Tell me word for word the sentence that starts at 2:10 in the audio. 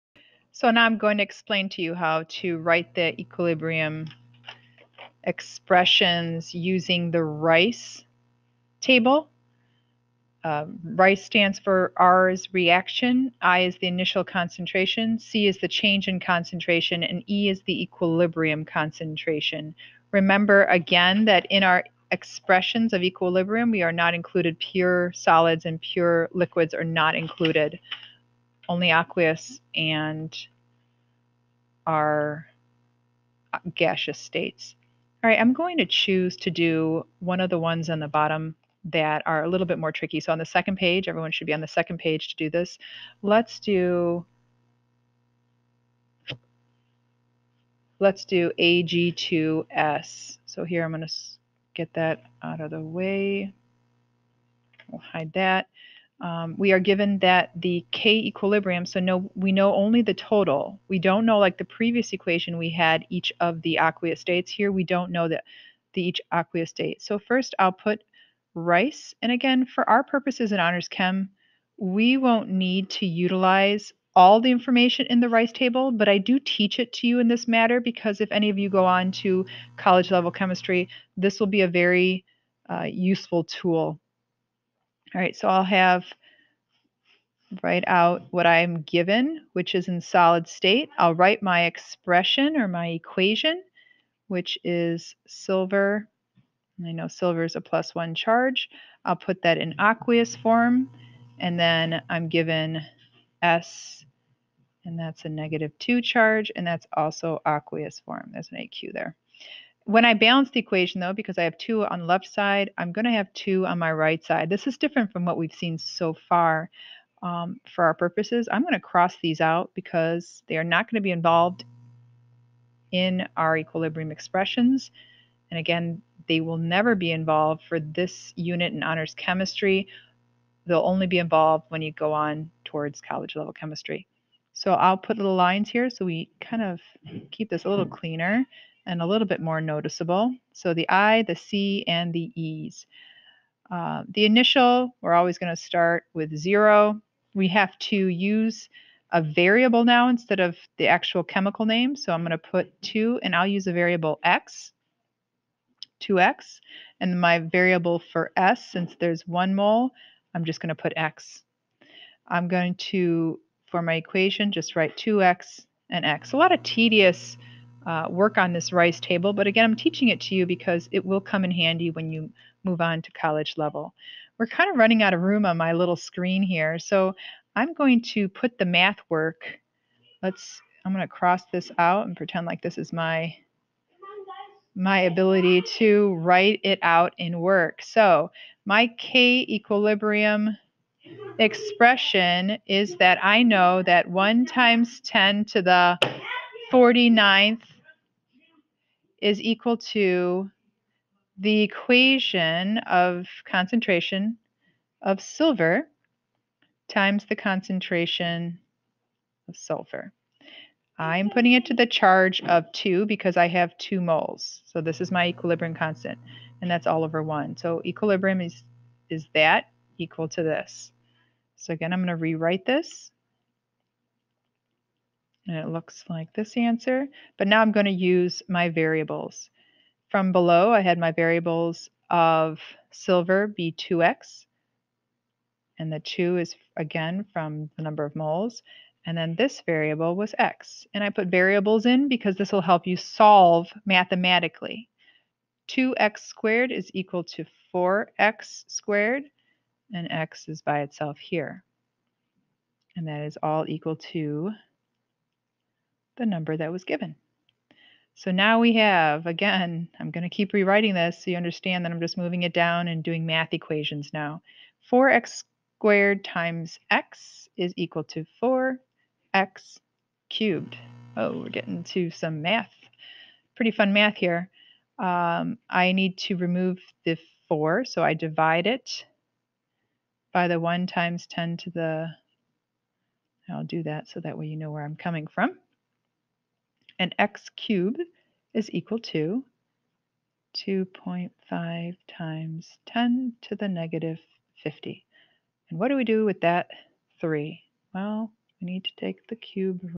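They'll only be involved when you go on towards college level chemistry.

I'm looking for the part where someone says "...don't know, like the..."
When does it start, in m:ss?
1:00.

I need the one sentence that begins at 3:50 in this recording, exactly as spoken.
From below, I had my variables of silver b 2x.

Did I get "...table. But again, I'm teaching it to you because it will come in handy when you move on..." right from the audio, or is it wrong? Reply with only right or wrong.
right.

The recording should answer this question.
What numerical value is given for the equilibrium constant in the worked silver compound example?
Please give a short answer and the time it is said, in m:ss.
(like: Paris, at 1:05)
1 x 10^49, at 3:14.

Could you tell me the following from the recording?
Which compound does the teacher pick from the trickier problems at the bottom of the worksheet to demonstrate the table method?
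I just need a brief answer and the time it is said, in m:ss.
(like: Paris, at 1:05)
Ag2S, at 0:48.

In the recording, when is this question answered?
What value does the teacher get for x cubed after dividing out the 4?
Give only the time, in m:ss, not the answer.
4:50.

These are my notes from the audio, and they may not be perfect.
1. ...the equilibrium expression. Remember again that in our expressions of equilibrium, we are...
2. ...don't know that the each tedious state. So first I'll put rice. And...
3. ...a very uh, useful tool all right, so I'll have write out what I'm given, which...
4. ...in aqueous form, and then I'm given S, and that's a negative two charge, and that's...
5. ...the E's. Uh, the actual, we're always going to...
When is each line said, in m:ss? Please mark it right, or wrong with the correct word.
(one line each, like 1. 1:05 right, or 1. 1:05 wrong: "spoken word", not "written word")
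1. 0:17 wrong: "concentration", not "expression"
2. 1:04 wrong: "aqueous", not "tedious"
3. 1:21 right
4. 1:39 right
5. 2:22 wrong: "initial", not "actual".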